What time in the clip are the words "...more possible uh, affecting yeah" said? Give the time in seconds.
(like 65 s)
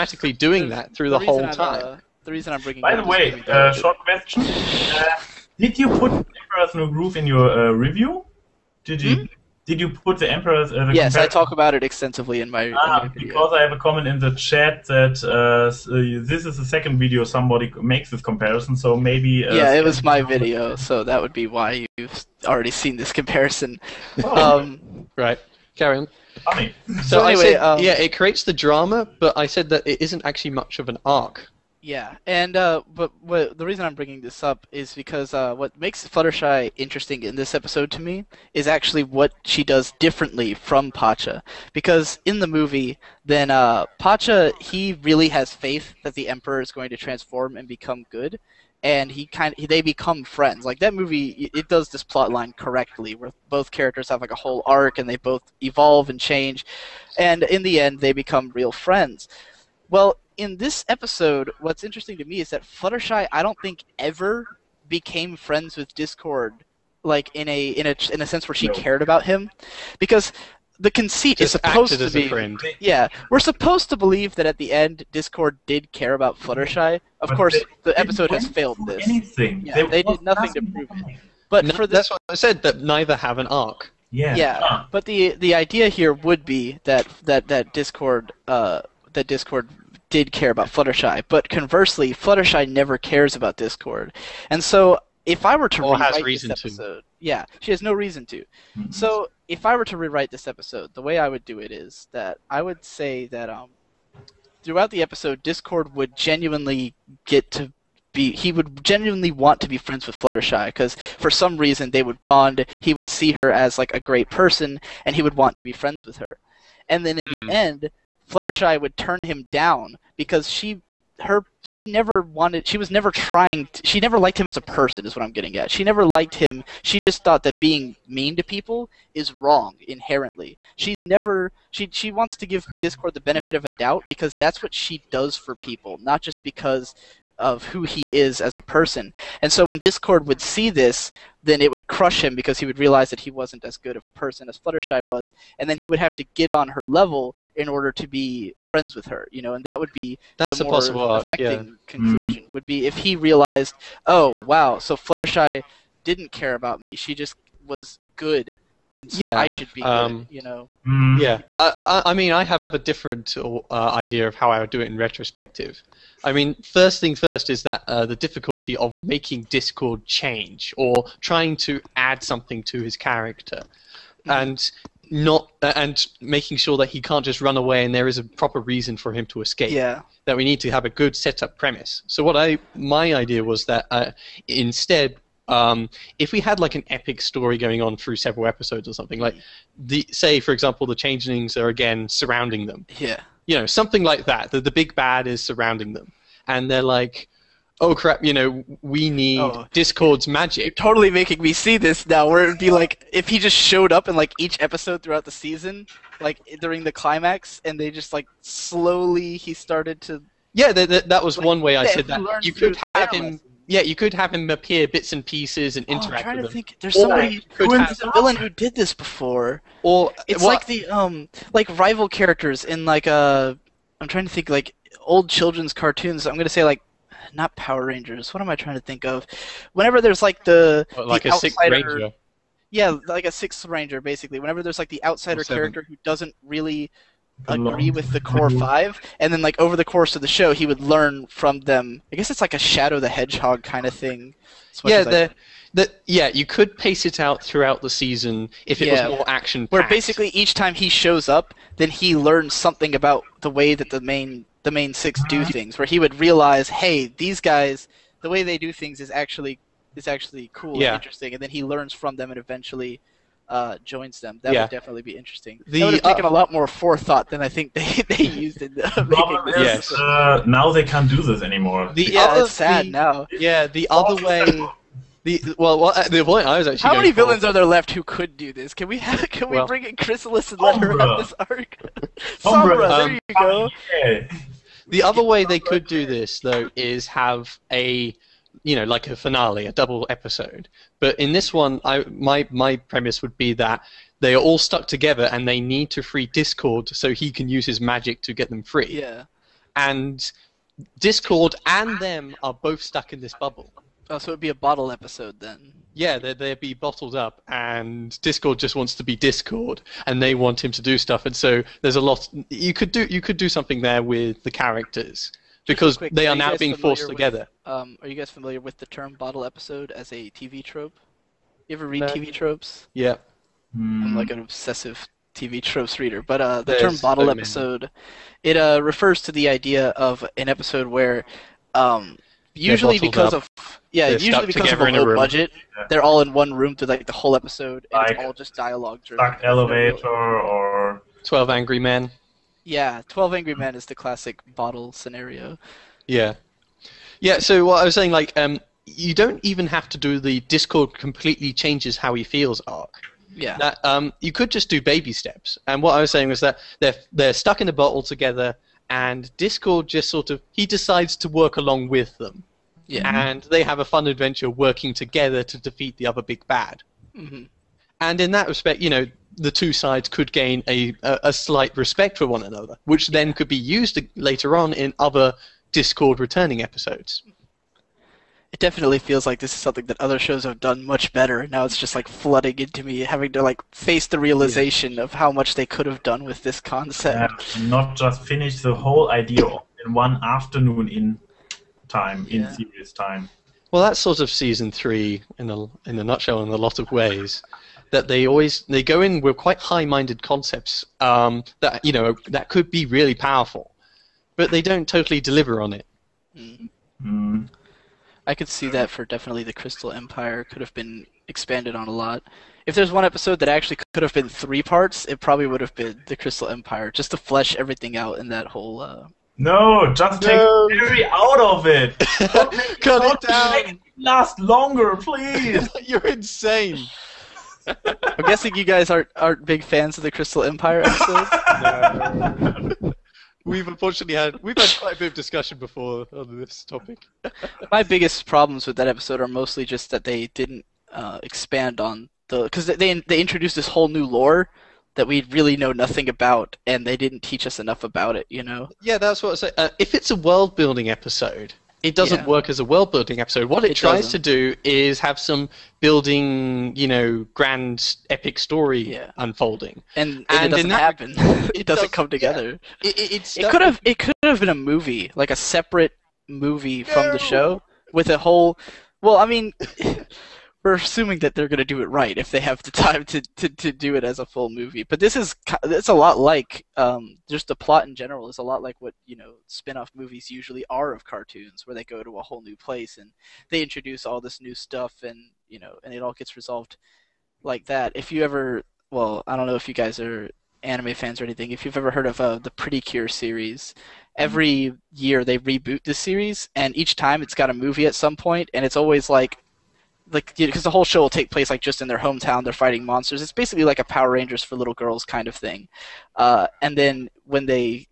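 150 s.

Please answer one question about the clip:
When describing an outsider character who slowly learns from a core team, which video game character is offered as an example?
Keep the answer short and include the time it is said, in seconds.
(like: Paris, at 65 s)
Shadow the Hedgehog, at 242 s.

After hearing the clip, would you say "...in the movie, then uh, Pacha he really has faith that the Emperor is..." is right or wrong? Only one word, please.
right.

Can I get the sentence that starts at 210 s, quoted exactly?
Yeah, that was like, one way I said that.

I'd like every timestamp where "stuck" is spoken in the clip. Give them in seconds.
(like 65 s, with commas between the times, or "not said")
294 s, 302 s, 357 s.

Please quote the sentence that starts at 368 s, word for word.
And in that respect, you know, the two sides could gain a, a, a slight respect for one another, which yeah.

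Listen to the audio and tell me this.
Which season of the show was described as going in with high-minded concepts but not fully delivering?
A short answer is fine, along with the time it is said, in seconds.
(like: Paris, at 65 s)
Season 3, at 394 s.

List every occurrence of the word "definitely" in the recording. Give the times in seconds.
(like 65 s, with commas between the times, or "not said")
264 s, 378 s, 409 s.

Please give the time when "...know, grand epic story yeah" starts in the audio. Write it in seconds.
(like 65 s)
456 s.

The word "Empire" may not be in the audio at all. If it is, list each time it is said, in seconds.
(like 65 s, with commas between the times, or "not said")
409 s, 416 s, 430 s.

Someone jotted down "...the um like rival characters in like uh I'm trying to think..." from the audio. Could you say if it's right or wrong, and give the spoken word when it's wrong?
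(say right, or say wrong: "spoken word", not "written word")
right.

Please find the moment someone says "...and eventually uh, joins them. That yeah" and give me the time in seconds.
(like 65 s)
262 s.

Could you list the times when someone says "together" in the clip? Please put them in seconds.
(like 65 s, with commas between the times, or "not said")
294 s, 317 s, 358 s, 364 s, 462 s.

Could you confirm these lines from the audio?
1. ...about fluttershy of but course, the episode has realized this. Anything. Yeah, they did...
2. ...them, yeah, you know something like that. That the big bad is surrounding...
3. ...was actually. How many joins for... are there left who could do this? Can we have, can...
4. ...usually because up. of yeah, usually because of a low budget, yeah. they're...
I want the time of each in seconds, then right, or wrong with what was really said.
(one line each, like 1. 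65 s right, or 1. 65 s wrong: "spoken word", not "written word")
1. 76 s wrong: "failed", not "realized"
2. 192 s right
3. 276 s wrong: "villains", not "joins"
4. 332 s right.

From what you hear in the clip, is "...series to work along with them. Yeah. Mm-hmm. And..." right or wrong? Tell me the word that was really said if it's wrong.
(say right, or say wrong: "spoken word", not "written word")
wrong: "decides", not "series".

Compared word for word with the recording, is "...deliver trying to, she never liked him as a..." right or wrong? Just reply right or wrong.
wrong.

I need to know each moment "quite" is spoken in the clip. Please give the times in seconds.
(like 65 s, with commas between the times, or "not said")
399 s, 434 s.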